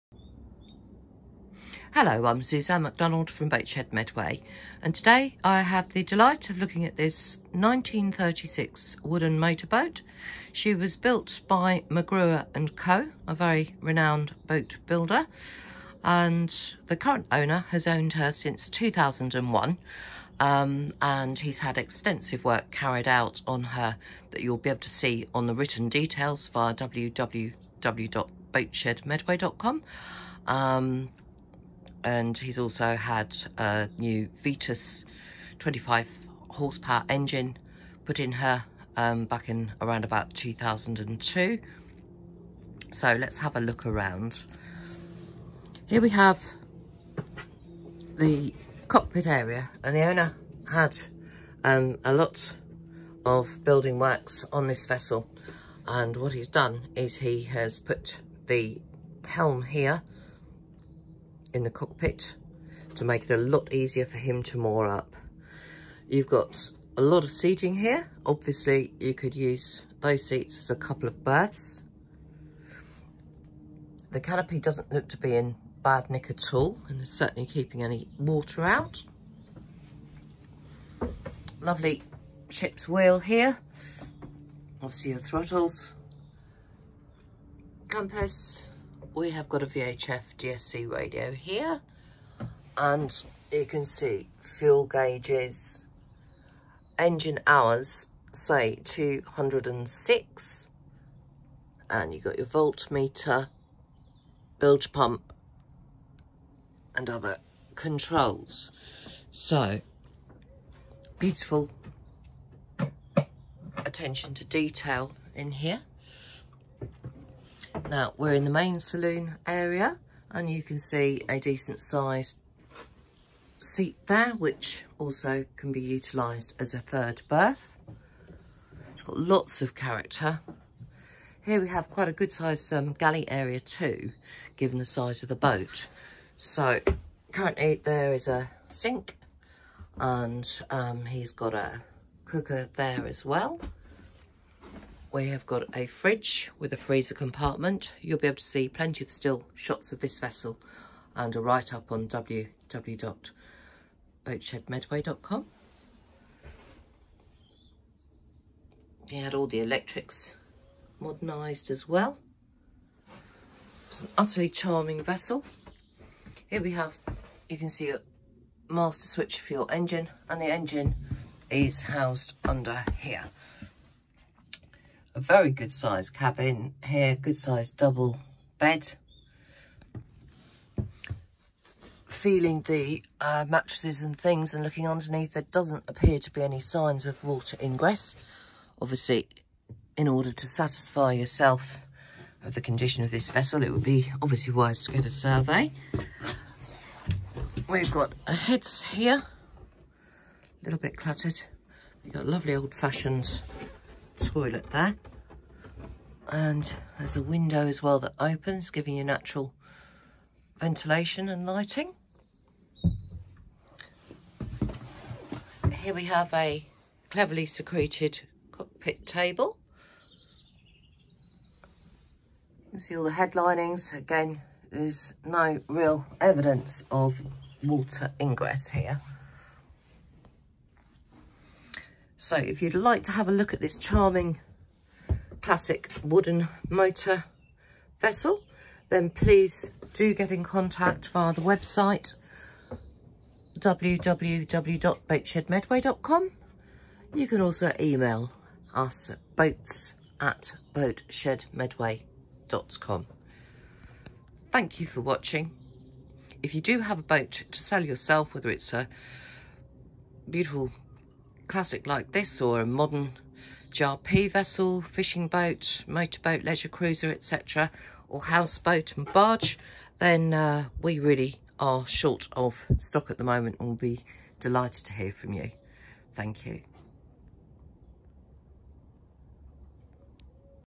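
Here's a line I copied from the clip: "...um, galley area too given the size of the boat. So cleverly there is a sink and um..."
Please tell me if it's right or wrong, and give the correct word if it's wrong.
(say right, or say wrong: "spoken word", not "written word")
wrong: "currently", not "cleverly".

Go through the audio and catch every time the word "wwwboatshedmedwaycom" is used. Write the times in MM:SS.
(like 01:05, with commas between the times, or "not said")
00:26, 02:32, 04:03.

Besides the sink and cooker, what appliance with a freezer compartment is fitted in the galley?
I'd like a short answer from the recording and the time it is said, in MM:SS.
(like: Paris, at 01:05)
fridge, at 02:25.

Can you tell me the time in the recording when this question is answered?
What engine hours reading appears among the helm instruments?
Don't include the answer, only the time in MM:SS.
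01:38.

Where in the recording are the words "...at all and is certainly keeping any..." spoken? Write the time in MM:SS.
01:16.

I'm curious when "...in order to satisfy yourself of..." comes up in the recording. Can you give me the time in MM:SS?
03:09.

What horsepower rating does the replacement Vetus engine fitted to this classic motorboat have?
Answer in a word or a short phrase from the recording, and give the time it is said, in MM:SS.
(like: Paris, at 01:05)
25, at 00:35.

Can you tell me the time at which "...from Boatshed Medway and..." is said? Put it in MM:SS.
00:03.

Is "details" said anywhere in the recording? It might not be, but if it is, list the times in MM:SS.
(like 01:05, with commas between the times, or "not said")
00:25, 01:54.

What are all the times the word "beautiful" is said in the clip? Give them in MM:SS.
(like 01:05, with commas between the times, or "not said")
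01:51, 04:20.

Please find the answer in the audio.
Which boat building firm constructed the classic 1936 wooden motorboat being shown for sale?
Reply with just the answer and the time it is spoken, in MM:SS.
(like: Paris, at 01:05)
McGruer and Co, at 00:11.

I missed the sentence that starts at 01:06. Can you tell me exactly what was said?
You've got a lot of seating here.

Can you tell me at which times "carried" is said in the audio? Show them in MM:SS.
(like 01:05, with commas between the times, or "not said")
00:22.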